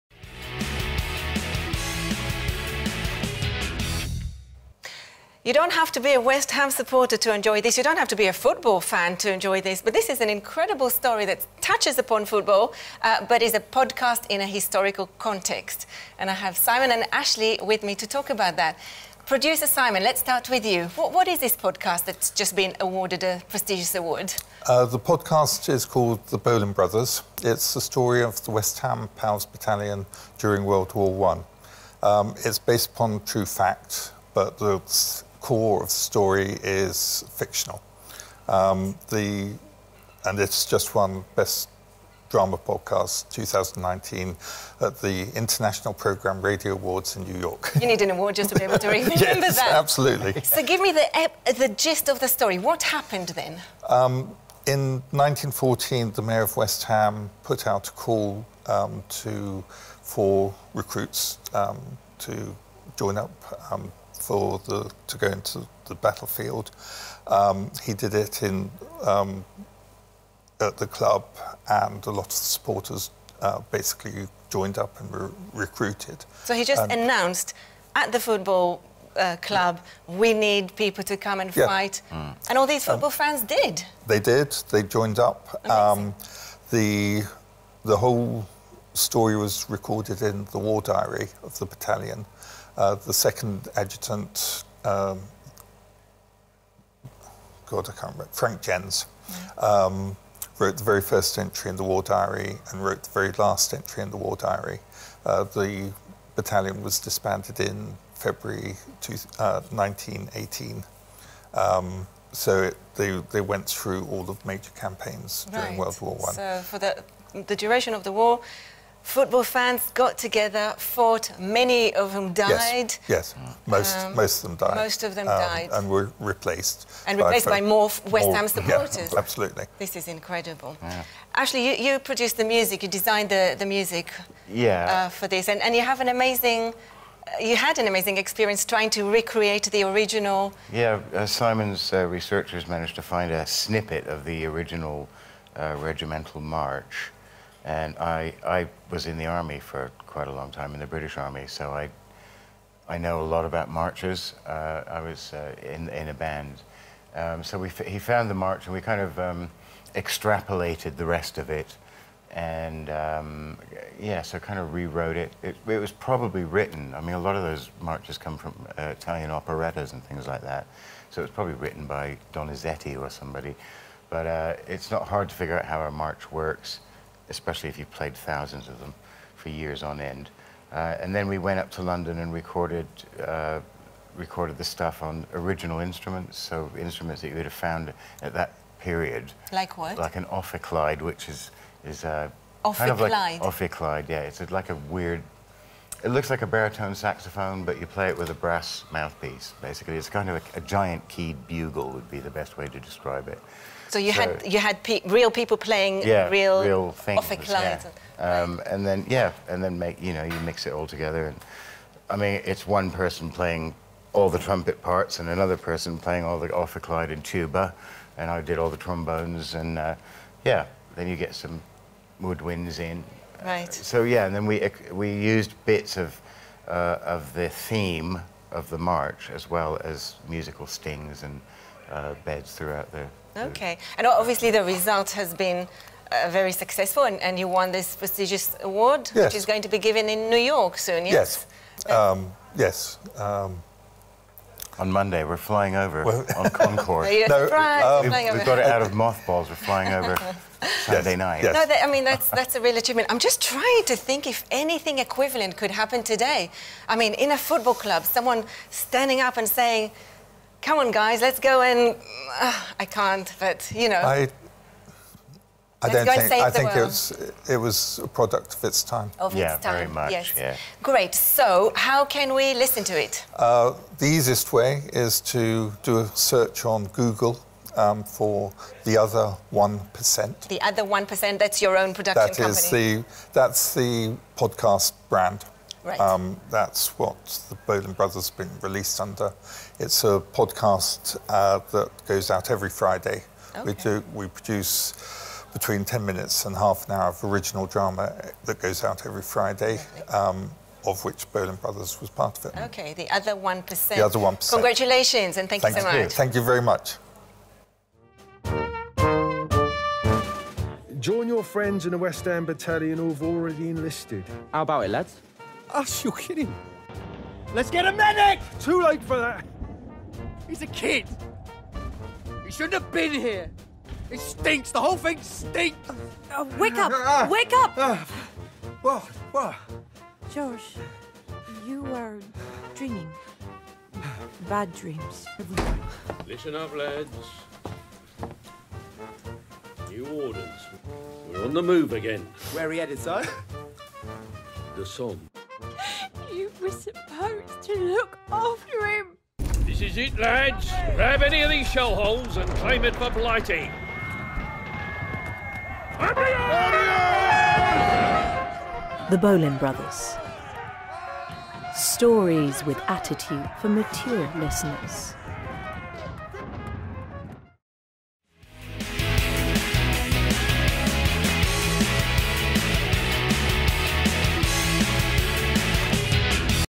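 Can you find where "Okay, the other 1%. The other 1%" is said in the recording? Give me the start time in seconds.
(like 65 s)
302 s.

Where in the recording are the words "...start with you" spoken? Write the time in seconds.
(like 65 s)
20 s.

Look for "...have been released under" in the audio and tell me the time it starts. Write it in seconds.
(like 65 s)
288 s.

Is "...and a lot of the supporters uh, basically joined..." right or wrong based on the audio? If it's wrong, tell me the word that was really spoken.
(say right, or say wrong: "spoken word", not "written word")
right.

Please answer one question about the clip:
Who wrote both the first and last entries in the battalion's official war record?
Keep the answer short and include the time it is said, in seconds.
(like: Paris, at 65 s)
Frank Jens, at 98 s.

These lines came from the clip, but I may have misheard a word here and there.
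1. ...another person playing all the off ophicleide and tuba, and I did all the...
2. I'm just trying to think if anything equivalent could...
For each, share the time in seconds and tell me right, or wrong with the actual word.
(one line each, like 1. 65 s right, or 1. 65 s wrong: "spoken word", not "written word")
1. 215 s right
2. 253 s right.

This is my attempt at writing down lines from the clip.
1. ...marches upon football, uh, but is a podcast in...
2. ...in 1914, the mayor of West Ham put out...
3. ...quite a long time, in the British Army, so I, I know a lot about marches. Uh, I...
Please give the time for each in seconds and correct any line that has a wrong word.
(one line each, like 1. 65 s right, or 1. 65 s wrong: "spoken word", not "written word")
1. 11 s wrong: "touches", not "marches"
2. 54 s right
3. 150 s right.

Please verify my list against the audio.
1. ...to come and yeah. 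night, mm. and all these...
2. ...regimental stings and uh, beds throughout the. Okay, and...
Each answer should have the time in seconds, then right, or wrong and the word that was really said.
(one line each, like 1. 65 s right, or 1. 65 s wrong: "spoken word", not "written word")
1. 81 s wrong: "fight", not "night"
2. 230 s wrong: "musical", not "regimental".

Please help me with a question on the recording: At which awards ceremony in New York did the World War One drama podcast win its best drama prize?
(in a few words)
International Programme Radio Awards.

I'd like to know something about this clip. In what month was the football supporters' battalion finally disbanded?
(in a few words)
February.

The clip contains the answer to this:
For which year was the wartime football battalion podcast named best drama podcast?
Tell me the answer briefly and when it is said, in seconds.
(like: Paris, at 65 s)
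2019, at 43 s.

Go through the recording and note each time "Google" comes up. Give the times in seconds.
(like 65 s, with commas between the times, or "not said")
276 s.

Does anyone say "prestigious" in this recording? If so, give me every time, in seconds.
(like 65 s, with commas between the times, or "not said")
23 s, 237 s.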